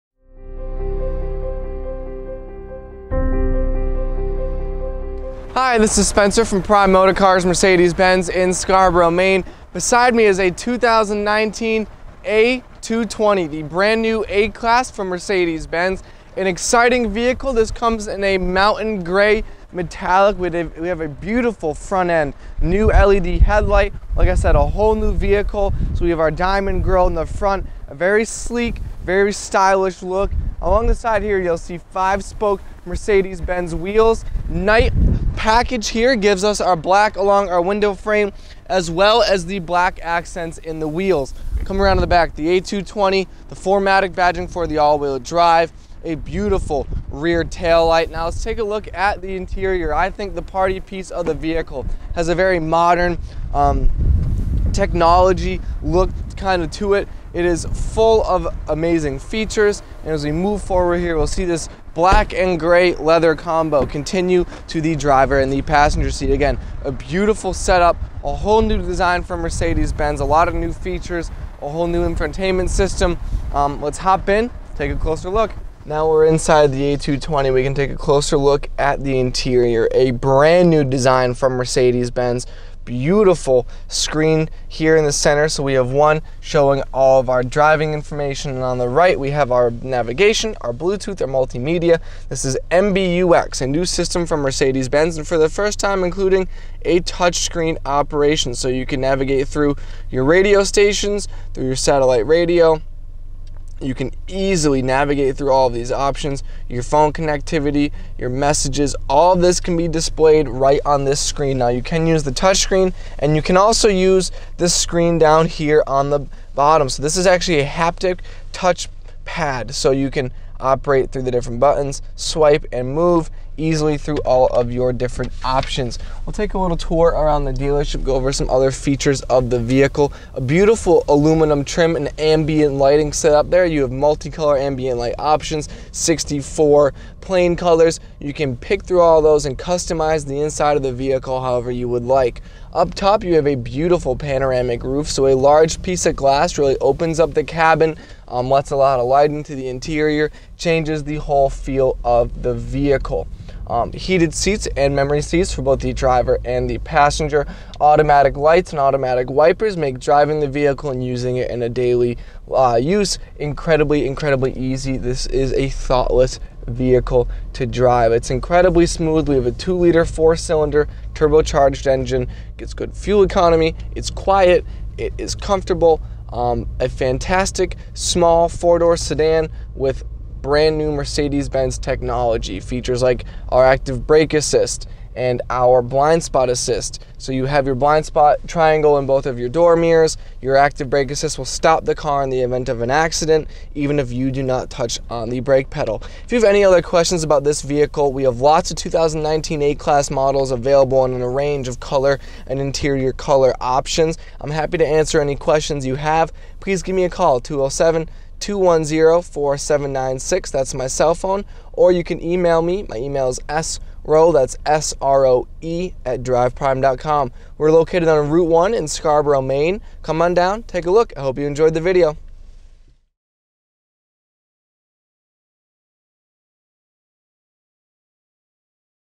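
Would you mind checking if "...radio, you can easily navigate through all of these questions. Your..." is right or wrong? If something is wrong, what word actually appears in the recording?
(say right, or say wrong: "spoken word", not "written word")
wrong: "options", not "questions".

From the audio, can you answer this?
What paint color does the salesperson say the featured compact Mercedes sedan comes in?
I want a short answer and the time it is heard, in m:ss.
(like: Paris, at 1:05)
Mountain gray metallic, at 0:18.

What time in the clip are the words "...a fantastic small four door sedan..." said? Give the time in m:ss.
2:56.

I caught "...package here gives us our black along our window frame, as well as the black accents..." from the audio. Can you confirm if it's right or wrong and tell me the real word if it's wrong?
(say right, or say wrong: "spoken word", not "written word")
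right.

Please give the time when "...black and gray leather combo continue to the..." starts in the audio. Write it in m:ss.
1:01.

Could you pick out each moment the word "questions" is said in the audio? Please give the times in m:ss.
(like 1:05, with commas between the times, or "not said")
3:16, 3:25.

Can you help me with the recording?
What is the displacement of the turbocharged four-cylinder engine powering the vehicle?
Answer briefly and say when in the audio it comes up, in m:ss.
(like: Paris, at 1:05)
2 liter, at 2:49.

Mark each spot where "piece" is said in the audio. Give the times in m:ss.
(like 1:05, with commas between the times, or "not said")
0:50, 2:25.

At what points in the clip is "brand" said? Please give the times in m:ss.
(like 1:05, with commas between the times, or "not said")
0:13, 1:20, 3:00.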